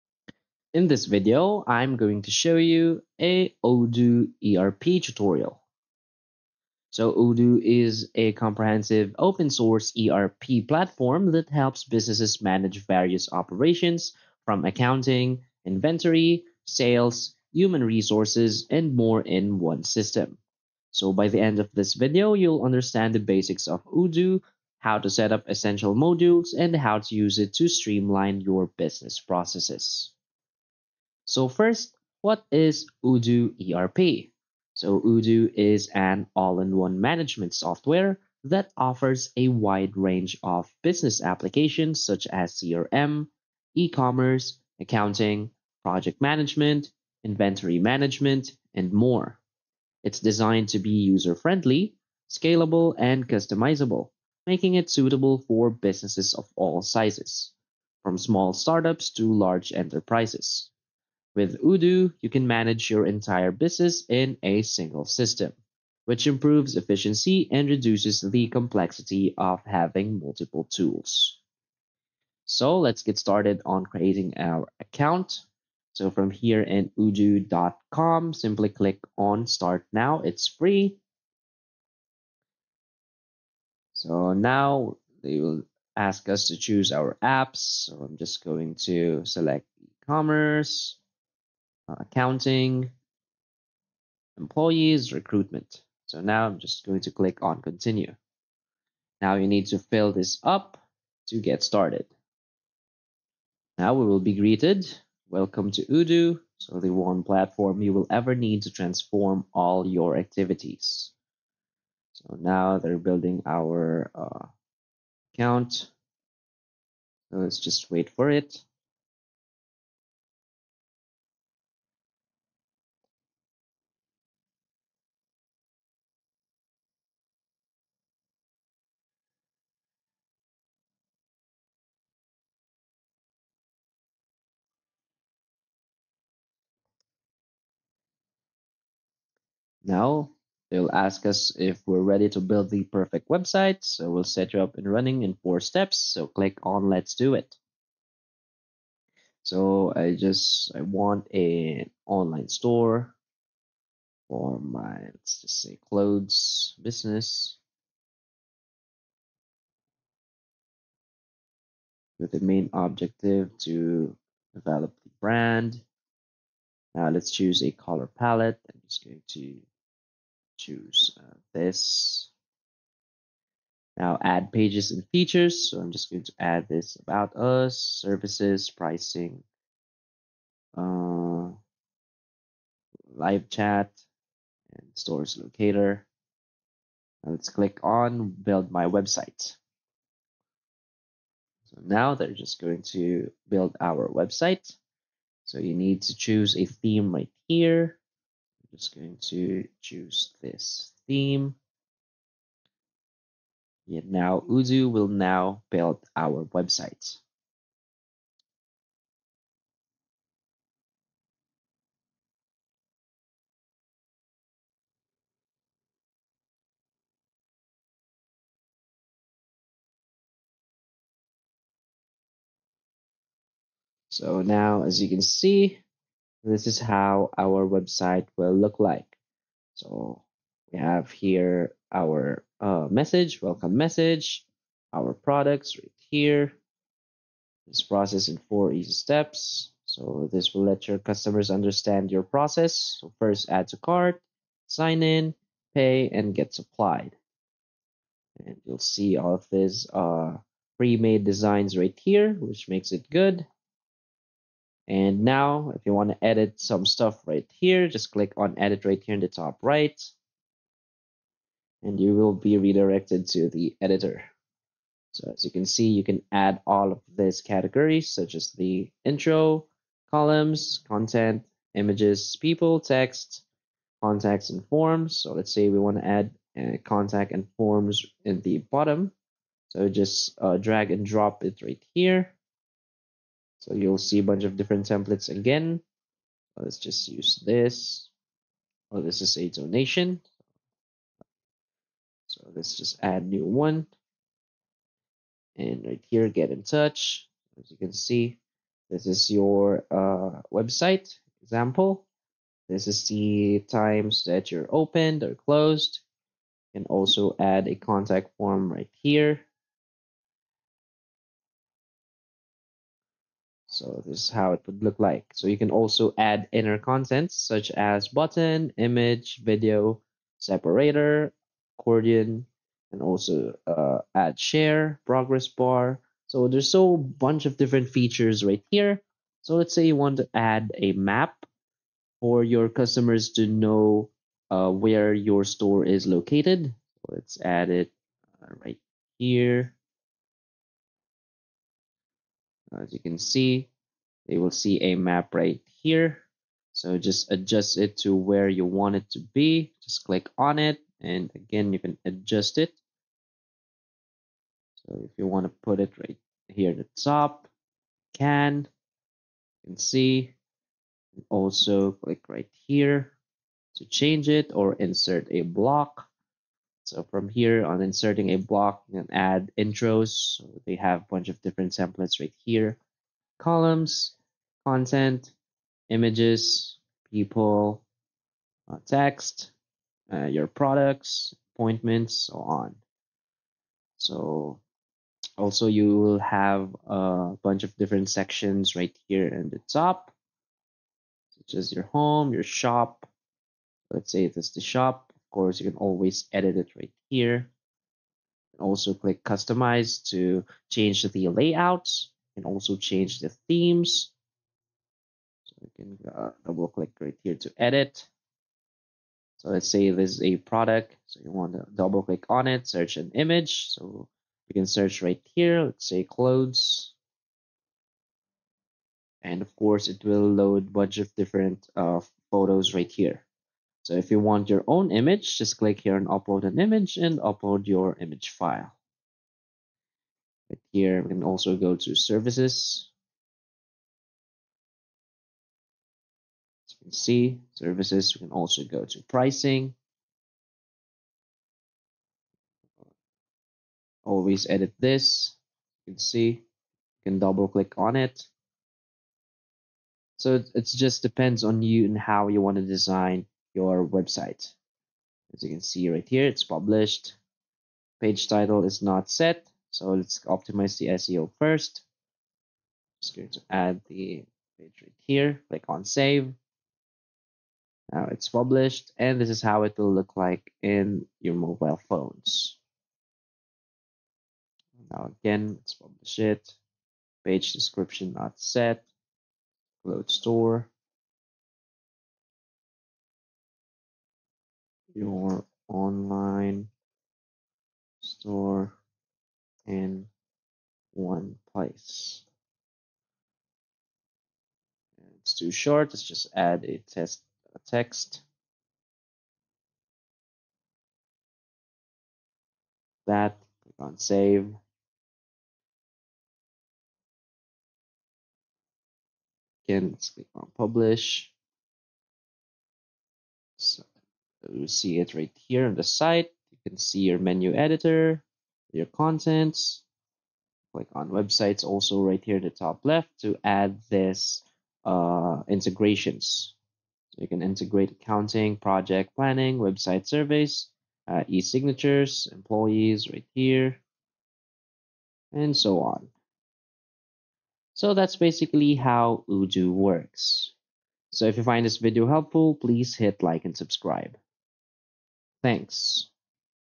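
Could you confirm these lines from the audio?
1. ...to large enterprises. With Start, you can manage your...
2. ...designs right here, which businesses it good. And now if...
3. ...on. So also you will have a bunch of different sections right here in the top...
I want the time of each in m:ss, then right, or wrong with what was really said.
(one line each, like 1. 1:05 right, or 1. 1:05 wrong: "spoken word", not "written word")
1. 0:59 wrong: "Odoo", not "Start"
2. 4:11 wrong: "makes", not "businesses"
3. 6:22 right.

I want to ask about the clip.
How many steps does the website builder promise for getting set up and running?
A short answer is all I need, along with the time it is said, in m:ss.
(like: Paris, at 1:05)
4, at 2:25.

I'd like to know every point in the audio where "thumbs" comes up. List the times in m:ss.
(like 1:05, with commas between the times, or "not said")
not said.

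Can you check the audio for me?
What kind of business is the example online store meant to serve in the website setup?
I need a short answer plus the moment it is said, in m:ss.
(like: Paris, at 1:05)
Clothes business, at 2:35.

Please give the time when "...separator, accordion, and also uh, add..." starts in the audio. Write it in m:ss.
5:20.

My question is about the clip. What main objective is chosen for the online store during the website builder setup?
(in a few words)
Develop the brand.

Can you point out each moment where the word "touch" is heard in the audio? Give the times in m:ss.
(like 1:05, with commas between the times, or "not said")
4:56.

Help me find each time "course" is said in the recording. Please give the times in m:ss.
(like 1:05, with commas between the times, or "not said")
6:35, 6:59.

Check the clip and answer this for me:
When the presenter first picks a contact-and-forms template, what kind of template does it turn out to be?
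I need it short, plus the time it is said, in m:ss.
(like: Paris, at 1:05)
Donation, at 4:49.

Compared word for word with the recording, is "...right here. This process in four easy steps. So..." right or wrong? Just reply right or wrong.
right.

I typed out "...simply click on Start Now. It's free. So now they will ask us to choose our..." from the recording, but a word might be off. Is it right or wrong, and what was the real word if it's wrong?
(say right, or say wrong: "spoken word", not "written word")
right.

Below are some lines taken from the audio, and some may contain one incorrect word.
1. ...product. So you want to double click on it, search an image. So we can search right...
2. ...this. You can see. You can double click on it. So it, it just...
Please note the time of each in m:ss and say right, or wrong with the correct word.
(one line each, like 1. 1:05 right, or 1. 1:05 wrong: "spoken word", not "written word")
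1. 6:50 right
2. 7:24 right.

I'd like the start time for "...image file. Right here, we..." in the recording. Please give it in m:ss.
7:07.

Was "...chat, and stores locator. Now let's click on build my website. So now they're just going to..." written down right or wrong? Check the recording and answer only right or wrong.
right.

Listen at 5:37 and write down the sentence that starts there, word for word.
Let's add it uh, right here.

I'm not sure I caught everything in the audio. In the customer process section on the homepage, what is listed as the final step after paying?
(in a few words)
Get supplied.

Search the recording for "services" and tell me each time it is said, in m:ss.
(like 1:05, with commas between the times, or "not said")
2:57, 7:11, 7:17.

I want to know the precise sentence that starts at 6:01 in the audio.
And also click right here to change it or insert a block.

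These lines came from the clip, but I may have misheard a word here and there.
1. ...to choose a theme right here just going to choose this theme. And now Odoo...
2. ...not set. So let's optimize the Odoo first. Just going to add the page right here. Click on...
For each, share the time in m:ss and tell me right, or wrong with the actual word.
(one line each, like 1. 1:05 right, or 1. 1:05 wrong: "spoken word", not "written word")
1. 3:16 right
2. 7:38 wrong: "SEO", not "Odoo".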